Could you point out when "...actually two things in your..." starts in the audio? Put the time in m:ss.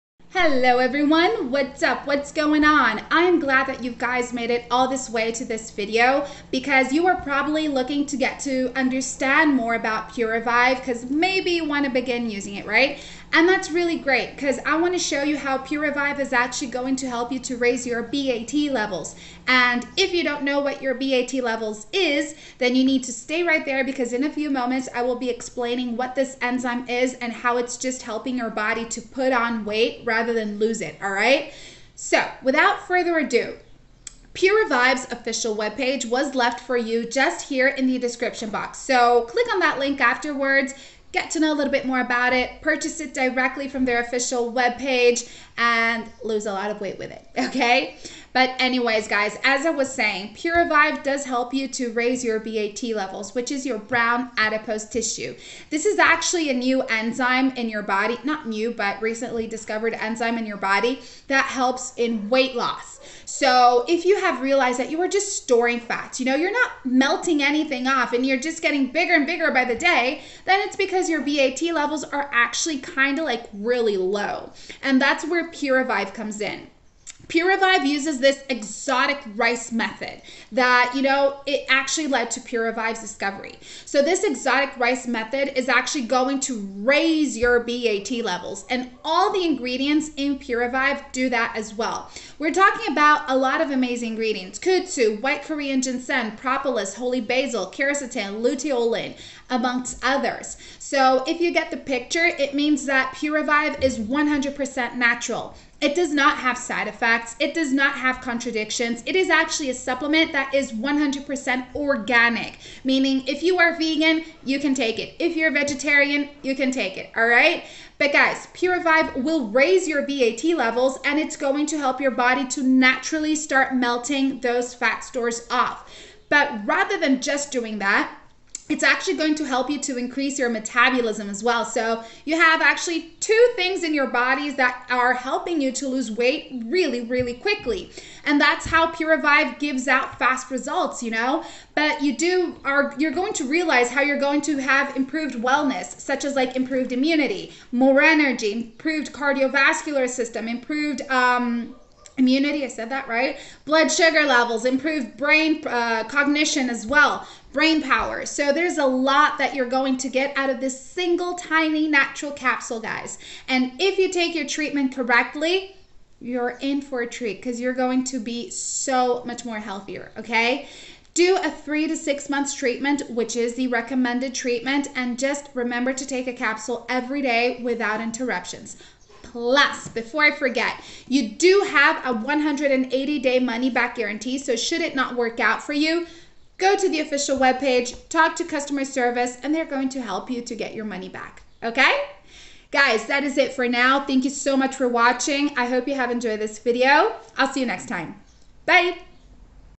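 2:12.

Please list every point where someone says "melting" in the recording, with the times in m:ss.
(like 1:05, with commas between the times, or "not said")
1:06, 2:03.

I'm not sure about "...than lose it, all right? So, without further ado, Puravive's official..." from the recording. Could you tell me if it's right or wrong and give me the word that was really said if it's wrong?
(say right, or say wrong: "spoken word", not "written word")
right.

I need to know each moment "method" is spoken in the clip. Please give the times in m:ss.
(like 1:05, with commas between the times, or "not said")
1:19, 1:25.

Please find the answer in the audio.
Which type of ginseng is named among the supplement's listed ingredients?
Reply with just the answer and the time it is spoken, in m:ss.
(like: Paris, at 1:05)
white Korean ginseng, at 1:35.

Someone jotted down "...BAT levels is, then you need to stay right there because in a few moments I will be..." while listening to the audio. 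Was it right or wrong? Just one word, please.
right.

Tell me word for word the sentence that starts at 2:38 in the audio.
So there's a lot that you're going to get out of this single tiny natural capsule, guys.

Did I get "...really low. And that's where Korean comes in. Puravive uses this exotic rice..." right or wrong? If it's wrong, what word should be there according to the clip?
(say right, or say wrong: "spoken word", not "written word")
wrong: "Puravive", not "Korean".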